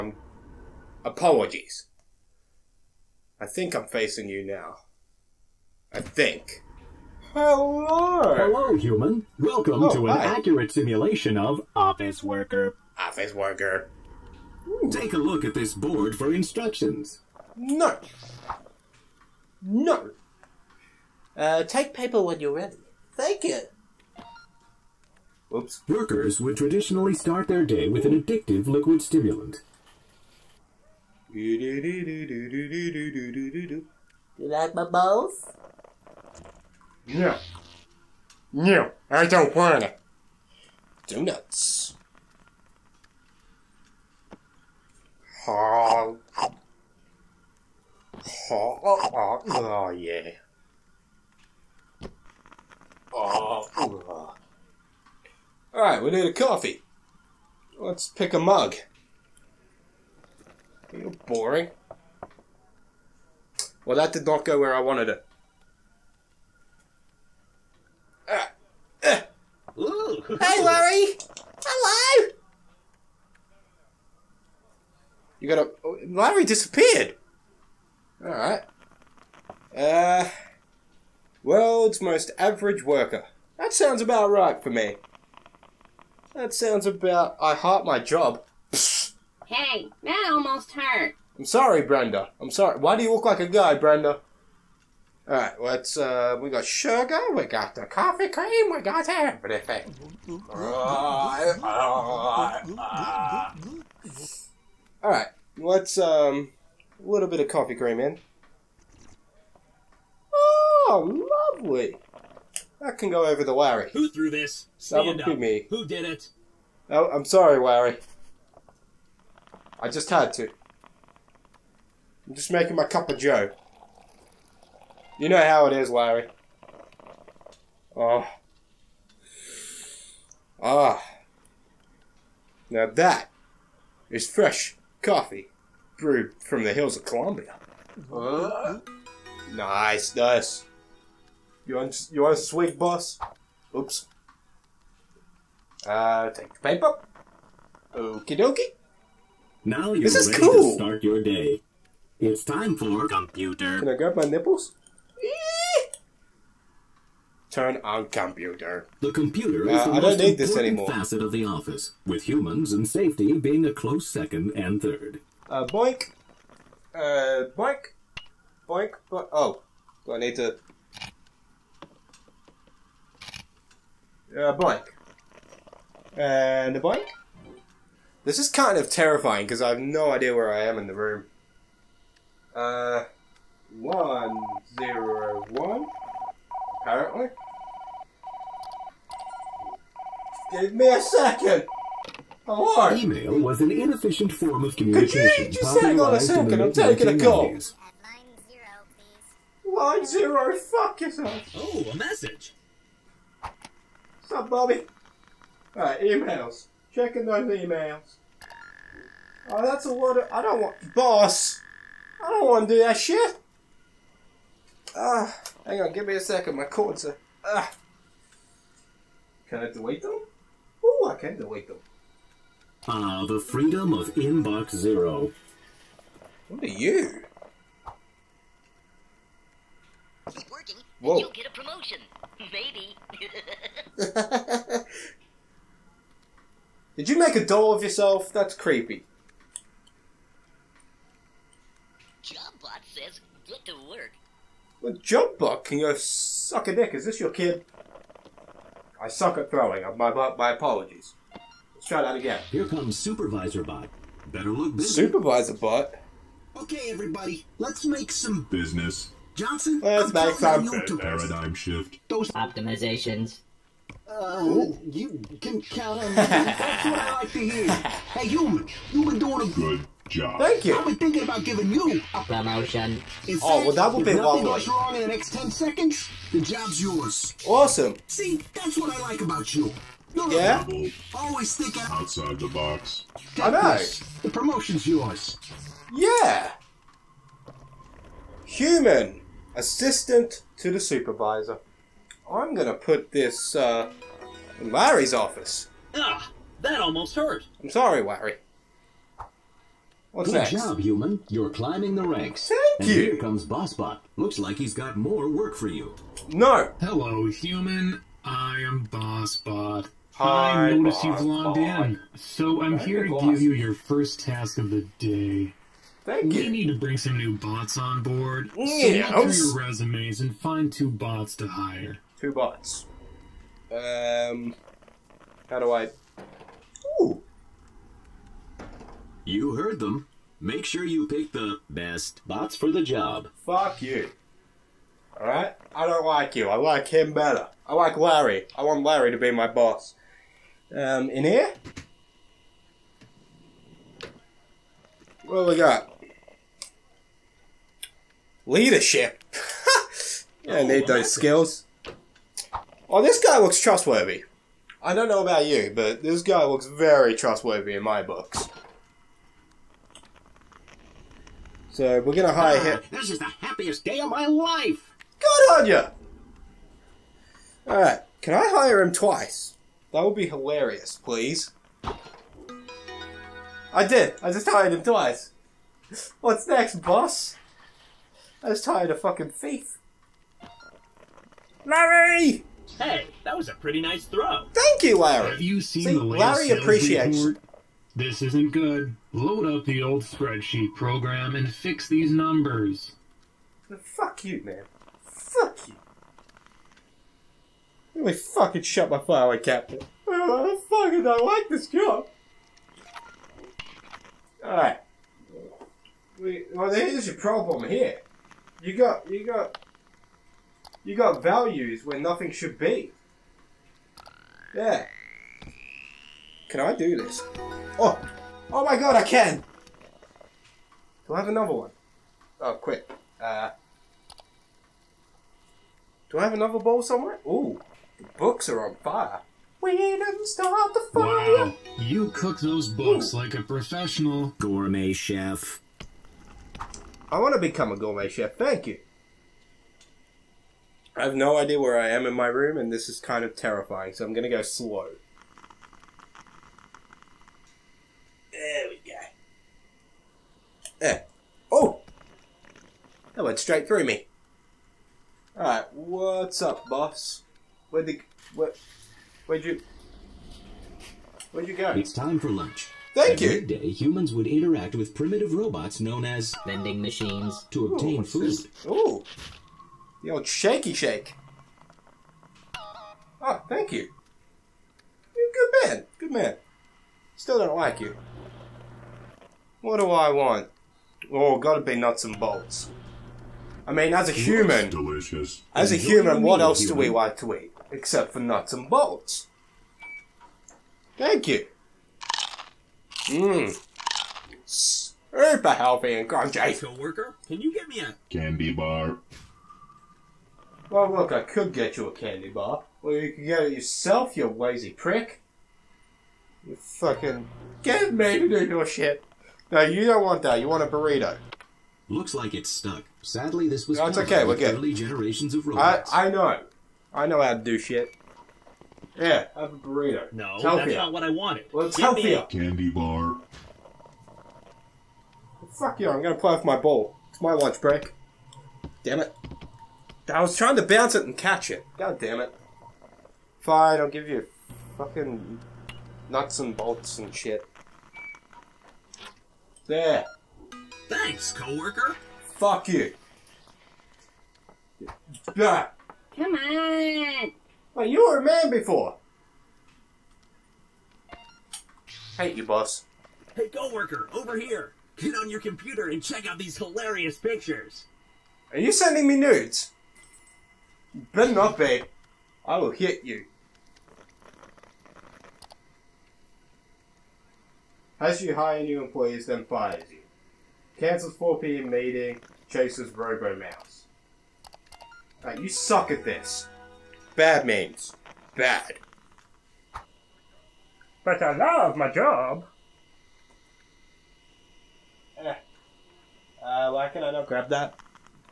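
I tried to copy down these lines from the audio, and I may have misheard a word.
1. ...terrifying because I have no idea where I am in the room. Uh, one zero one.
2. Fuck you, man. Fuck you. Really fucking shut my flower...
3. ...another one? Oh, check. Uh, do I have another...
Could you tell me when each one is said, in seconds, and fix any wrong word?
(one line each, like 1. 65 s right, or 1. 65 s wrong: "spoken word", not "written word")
1. 178 s right
2. 393 s right
3. 421 s wrong: "quick", not "check".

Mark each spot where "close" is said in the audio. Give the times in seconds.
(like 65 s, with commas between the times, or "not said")
163 s.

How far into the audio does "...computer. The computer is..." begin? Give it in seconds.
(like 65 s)
158 s.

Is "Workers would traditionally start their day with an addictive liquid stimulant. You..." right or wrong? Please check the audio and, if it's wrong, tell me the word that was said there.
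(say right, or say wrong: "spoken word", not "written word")
right.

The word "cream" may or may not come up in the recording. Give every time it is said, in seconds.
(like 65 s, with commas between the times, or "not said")
98 s, 107 s.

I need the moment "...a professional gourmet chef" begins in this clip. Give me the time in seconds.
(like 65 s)
433 s.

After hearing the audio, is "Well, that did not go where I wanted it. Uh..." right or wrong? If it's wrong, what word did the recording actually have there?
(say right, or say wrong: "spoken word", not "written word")
right.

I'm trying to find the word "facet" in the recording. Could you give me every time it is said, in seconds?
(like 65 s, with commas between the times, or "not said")
160 s.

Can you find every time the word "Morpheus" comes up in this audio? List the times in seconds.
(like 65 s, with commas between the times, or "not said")
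not said.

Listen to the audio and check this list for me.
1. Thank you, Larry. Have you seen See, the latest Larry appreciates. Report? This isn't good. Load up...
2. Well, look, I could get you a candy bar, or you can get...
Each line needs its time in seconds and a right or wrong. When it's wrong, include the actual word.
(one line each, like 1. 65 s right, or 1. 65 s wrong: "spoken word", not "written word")
1. 384 s right
2. 500 s right.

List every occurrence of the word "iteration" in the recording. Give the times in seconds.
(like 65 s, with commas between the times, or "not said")
not said.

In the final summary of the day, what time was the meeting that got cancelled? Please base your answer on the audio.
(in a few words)
4 p.m.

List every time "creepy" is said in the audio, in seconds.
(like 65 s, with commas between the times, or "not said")
238 s.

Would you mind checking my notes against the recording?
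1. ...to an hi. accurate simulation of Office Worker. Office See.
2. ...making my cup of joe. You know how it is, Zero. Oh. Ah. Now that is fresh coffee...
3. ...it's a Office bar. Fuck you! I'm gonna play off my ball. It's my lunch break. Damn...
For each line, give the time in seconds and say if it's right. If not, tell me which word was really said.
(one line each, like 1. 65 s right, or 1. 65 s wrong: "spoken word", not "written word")
1. 9 s wrong: "Worker", not "See"
2. 122 s wrong: "Larry", not "Zero"
3. 521 s wrong: "Candy", not "Office".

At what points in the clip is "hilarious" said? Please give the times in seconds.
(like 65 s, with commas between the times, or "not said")
370 s, 556 s.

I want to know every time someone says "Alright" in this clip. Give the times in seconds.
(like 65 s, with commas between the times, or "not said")
55 s, 78 s, 205 s, 335 s, 404 s, 455 s.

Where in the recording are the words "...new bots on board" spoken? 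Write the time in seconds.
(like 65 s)
317 s.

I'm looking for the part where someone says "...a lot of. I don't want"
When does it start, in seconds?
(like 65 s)
209 s.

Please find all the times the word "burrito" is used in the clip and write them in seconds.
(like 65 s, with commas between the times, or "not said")
510 s, 519 s.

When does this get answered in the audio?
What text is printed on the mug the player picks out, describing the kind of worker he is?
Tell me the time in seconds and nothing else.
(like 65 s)
81 s.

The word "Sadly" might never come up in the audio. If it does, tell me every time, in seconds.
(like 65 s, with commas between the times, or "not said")
513 s.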